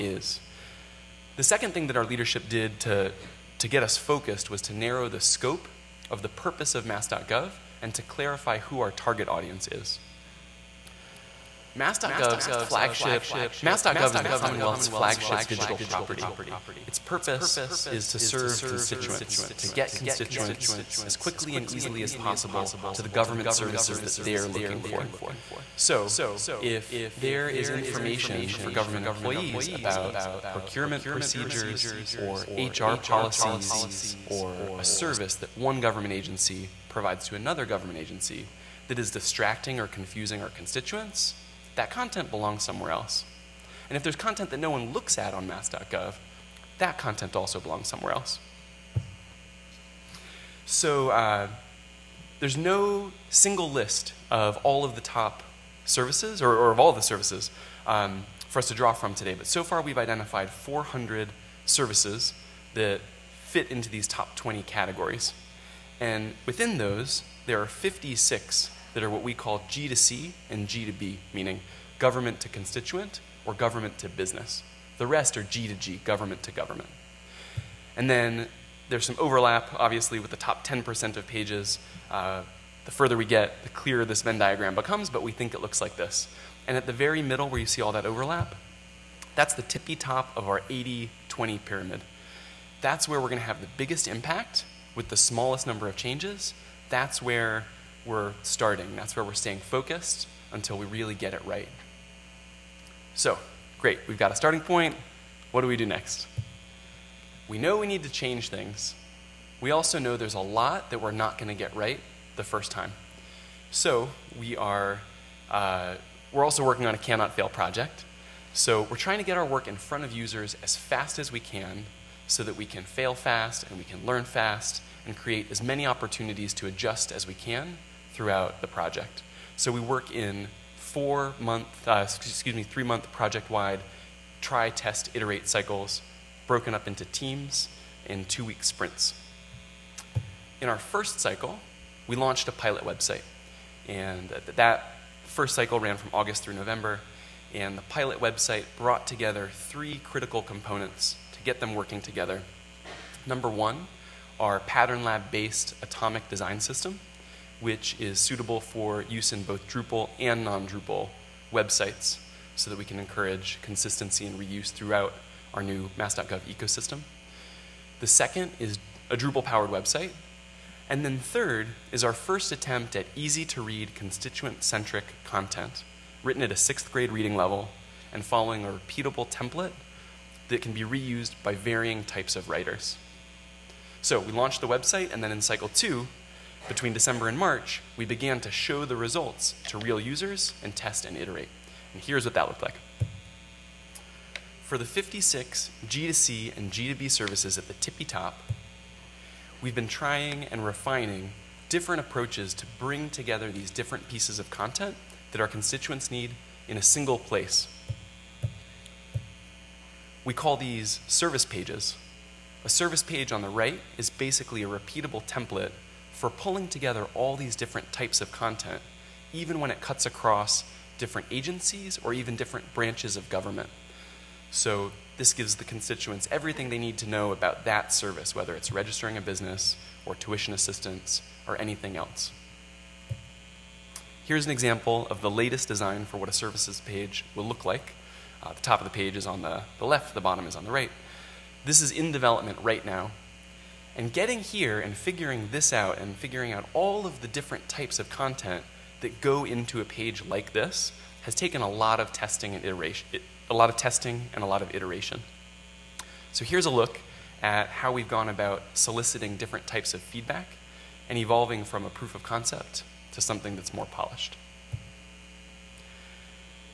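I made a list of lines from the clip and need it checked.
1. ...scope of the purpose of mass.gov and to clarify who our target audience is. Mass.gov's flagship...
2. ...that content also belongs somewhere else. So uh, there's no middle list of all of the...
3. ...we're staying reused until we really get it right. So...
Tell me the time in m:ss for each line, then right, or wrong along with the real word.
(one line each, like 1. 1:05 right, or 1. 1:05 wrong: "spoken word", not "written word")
1. 0:05 right
2. 0:46 wrong: "single", not "middle"
3. 1:39 wrong: "focused", not "reused".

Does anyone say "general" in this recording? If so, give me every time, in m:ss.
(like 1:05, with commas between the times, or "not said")
not said.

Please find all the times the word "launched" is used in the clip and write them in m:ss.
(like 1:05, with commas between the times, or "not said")
2:22, 3:04.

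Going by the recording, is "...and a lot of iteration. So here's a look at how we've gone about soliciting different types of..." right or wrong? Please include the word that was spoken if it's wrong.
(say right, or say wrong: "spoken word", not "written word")
right.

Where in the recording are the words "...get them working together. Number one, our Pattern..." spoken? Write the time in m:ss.
2:31.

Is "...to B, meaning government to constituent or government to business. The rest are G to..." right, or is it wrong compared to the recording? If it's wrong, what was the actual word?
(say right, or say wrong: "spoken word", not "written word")
right.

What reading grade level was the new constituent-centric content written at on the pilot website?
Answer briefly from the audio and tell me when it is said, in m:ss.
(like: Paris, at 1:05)
sixth grade, at 2:56.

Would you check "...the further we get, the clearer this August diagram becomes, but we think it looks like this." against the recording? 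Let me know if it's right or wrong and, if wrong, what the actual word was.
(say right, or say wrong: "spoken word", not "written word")
wrong: "Venn", not "August".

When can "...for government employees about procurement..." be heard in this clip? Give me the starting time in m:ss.
0:28.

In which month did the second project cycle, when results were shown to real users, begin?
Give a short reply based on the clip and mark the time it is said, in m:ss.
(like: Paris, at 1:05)
December, at 3:06.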